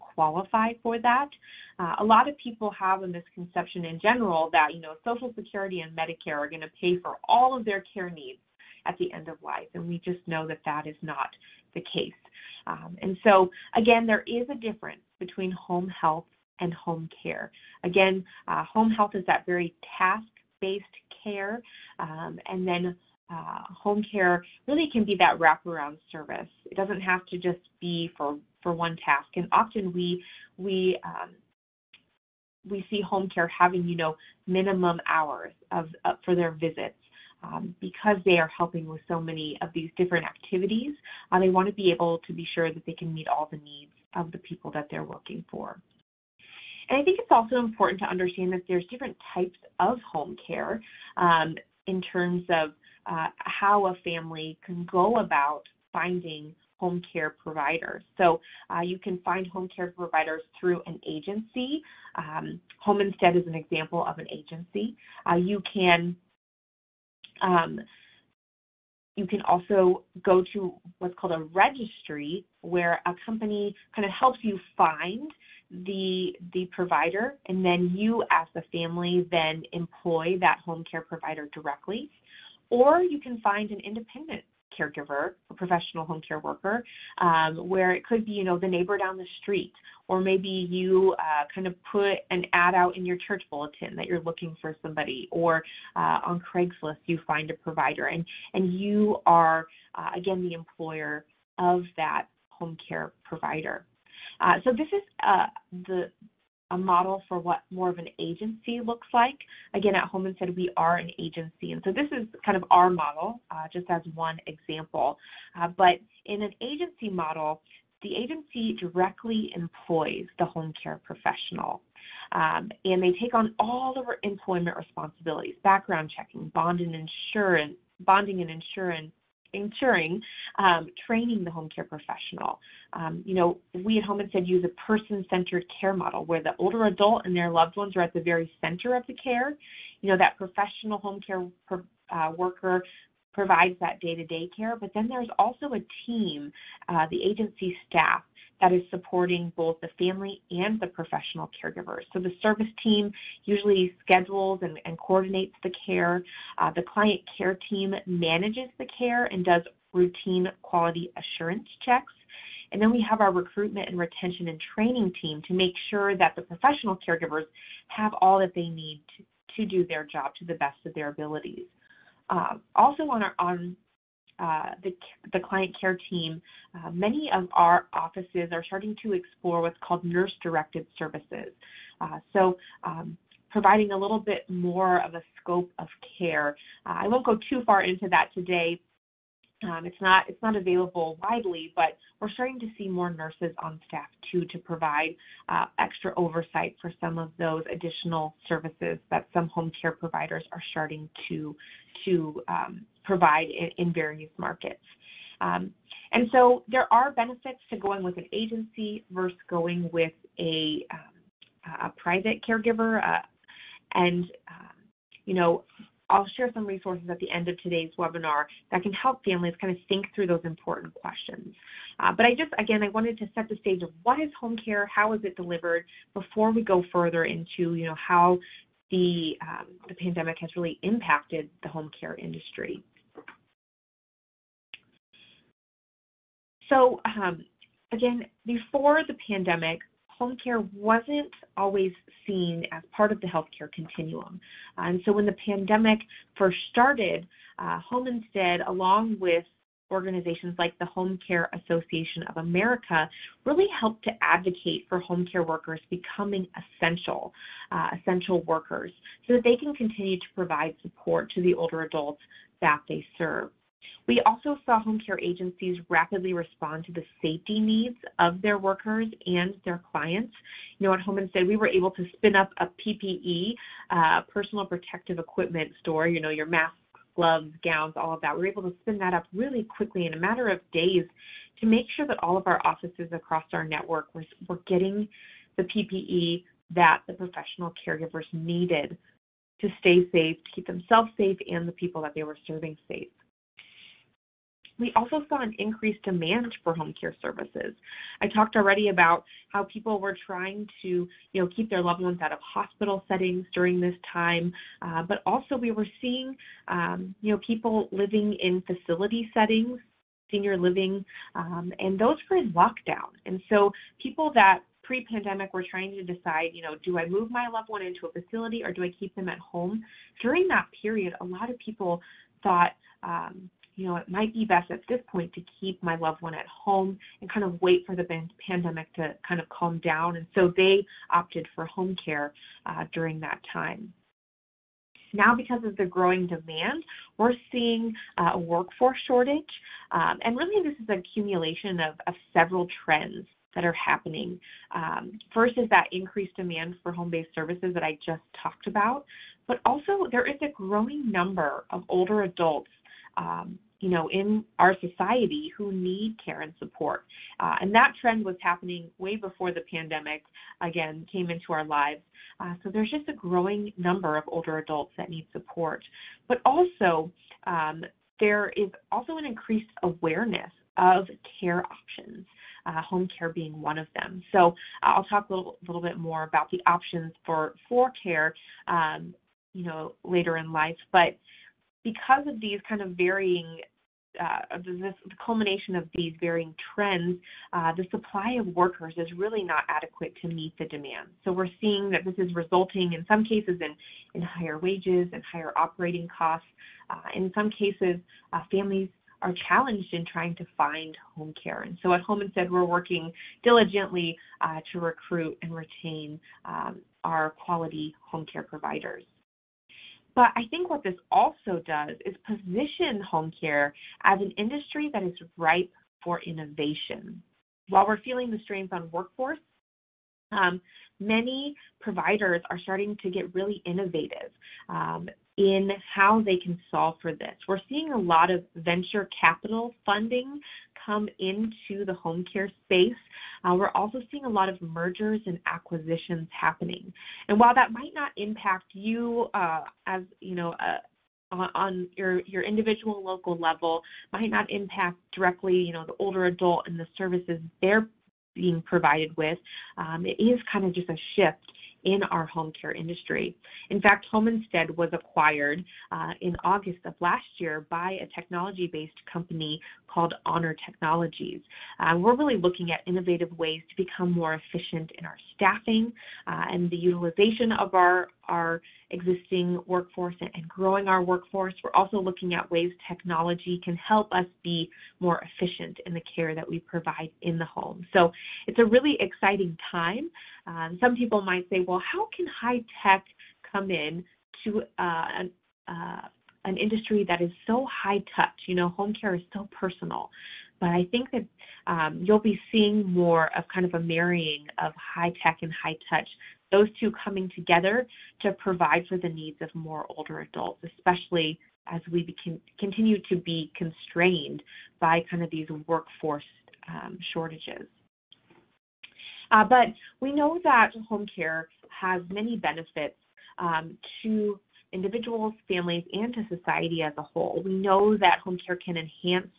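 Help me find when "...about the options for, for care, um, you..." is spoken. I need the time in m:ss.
6:16.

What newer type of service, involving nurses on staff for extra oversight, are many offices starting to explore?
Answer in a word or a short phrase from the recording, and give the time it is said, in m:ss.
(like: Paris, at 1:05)
Nurse directed services, at 3:00.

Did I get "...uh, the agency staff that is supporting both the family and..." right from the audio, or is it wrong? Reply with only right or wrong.
right.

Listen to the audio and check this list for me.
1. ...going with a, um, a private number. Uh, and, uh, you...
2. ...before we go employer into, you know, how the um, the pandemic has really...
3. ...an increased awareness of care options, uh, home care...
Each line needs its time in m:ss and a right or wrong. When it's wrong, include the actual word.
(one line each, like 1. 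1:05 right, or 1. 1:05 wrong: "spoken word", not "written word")
1. 3:29 wrong: "caregiver", not "number"
2. 3:46 wrong: "further", not "employer"
3. 6:09 right.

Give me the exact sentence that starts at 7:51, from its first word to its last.
We're also looking at ways technology can help us be more efficient in the care that we provide in the home.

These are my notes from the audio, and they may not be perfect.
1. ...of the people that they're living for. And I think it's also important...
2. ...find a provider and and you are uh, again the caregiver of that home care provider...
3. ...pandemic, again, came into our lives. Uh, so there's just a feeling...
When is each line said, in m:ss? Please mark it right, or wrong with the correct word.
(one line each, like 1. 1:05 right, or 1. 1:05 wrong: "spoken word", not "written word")
1. 0:44 wrong: "working", not "living"
2. 1:37 wrong: "employer", not "caregiver"
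3. 5:59 wrong: "growing", not "feeling".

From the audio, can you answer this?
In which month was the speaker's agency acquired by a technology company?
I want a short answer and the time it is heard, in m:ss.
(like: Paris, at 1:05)
August, at 7:36.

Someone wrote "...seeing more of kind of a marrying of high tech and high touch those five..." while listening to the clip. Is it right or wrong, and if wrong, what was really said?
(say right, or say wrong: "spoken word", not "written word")
wrong: "two", not "five".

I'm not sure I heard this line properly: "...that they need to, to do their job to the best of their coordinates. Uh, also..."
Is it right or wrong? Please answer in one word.
wrong.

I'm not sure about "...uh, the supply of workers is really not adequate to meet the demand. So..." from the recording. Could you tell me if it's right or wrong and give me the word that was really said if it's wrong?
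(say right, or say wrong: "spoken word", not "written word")
right.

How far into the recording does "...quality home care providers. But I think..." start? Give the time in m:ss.
6:47.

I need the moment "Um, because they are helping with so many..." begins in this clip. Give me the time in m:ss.
0:37.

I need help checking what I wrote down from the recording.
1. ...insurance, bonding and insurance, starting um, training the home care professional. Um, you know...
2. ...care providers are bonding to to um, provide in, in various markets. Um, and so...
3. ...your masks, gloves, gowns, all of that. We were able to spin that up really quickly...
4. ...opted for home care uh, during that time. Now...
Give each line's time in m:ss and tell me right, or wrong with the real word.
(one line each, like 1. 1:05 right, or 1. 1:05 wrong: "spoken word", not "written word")
1. 2:06 wrong: "ensuring", not "starting"
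2. 3:19 wrong: "starting", not "bonding"
3. 4:36 right
4. 5:31 right.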